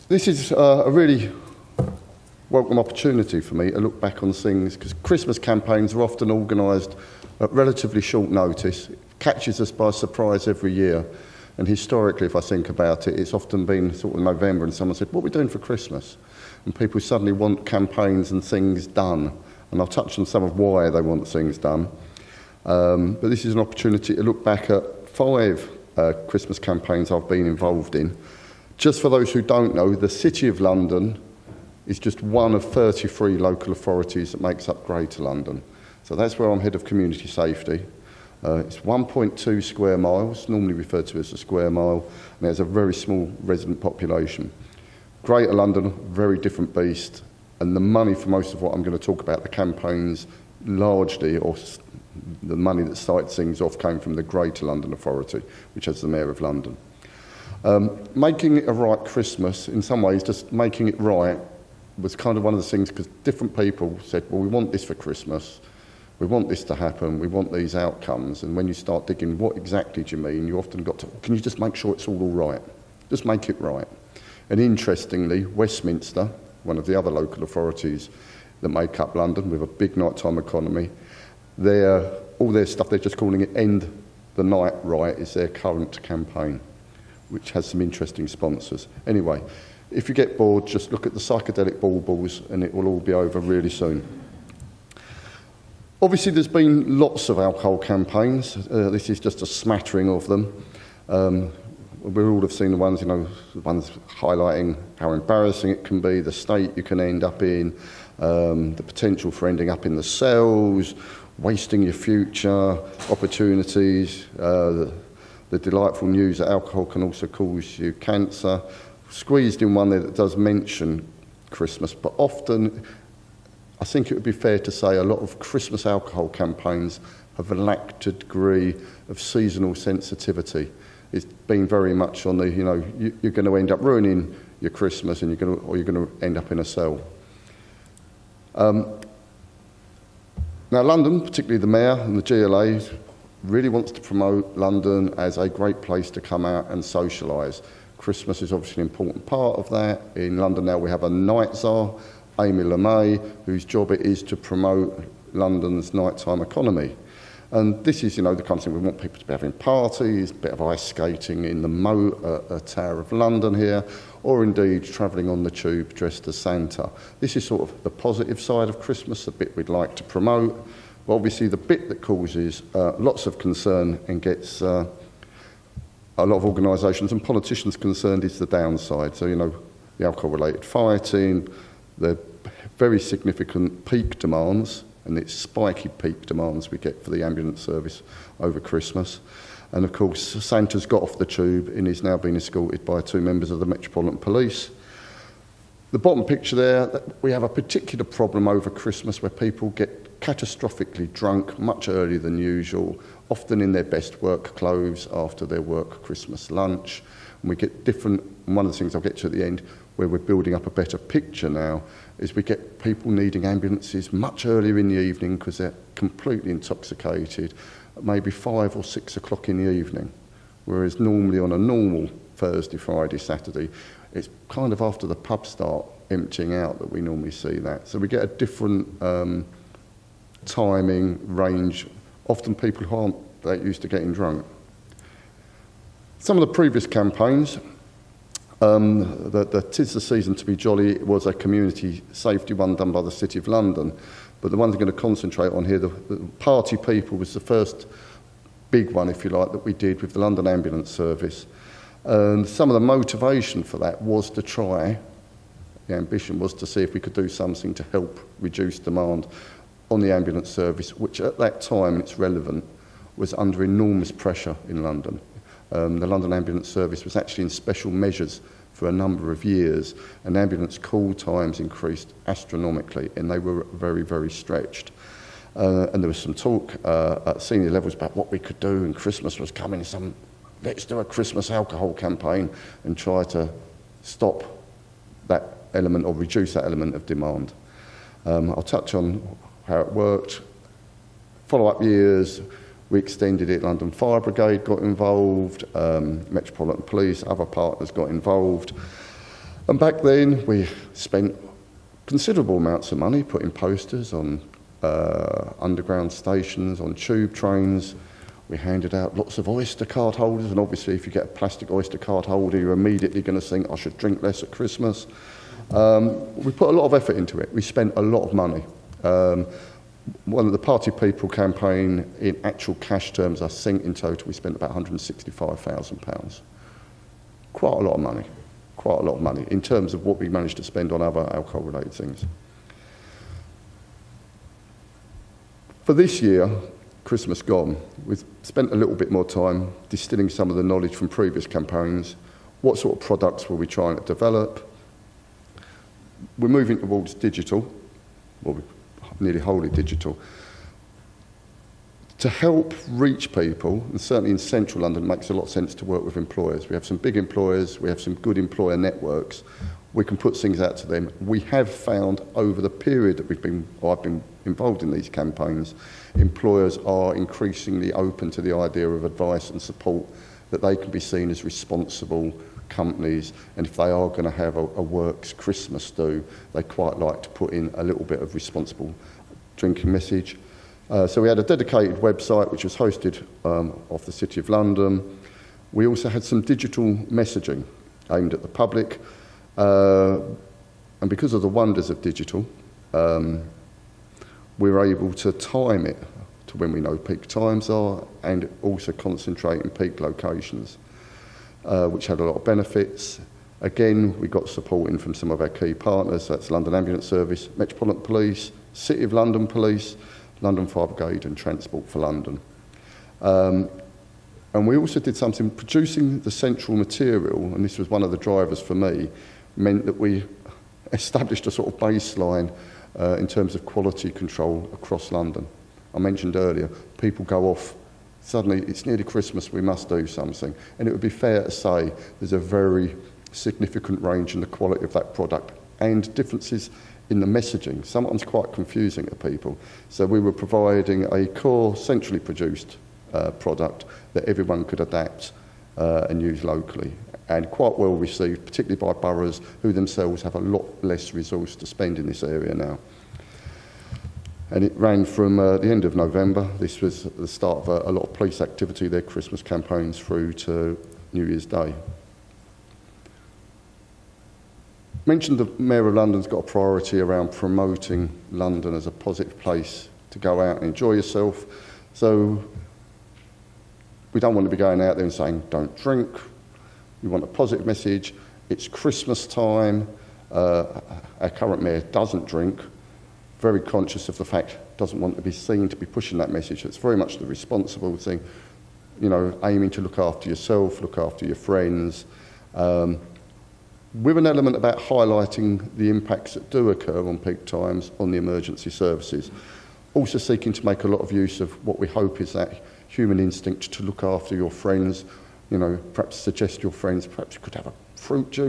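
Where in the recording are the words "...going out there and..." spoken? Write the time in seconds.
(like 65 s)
474 s.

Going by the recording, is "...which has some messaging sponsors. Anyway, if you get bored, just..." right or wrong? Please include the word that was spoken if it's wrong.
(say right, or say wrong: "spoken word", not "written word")
wrong: "interesting", not "messaging".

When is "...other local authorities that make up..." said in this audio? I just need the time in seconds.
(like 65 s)
76 s.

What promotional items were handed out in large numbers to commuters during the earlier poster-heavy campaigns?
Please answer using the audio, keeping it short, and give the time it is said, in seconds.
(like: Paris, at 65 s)
oyster card holders, at 309 s.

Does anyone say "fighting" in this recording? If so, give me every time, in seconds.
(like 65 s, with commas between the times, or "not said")
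180 s.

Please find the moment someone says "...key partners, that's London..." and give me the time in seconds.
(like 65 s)
405 s.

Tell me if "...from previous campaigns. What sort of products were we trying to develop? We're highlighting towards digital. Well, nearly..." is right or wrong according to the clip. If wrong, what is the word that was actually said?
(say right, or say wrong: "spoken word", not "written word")
wrong: "moving", not "highlighting".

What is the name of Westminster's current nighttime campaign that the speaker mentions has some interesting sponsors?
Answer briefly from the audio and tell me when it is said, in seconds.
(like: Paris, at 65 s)
End the Night Right, at 83 s.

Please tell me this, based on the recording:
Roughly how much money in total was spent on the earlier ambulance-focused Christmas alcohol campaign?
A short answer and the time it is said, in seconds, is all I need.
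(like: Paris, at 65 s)
£165,000, at 324 s.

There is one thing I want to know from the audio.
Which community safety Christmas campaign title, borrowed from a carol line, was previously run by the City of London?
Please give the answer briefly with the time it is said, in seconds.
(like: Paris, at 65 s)
Tis the Season to be Jolly, at 239 s.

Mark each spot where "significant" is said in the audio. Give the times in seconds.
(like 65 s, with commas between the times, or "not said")
182 s, 433 s.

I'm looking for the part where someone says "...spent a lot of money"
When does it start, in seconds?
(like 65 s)
317 s.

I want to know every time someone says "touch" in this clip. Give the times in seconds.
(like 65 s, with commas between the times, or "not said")
19 s, 288 s.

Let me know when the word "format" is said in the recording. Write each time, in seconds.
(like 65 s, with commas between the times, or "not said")
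not said.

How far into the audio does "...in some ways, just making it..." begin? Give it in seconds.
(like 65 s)
59 s.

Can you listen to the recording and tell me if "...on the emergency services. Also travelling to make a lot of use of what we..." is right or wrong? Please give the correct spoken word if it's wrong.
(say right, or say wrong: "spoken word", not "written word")
wrong: "seeking", not "travelling".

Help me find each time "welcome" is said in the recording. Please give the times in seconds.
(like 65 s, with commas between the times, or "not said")
2 s.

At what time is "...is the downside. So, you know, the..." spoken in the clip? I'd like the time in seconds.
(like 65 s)
178 s.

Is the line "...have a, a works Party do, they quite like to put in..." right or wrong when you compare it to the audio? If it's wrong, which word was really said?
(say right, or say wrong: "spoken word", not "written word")
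wrong: "Christmas", not "Party".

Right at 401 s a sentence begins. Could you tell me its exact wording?
uh, which had a lot of benefits.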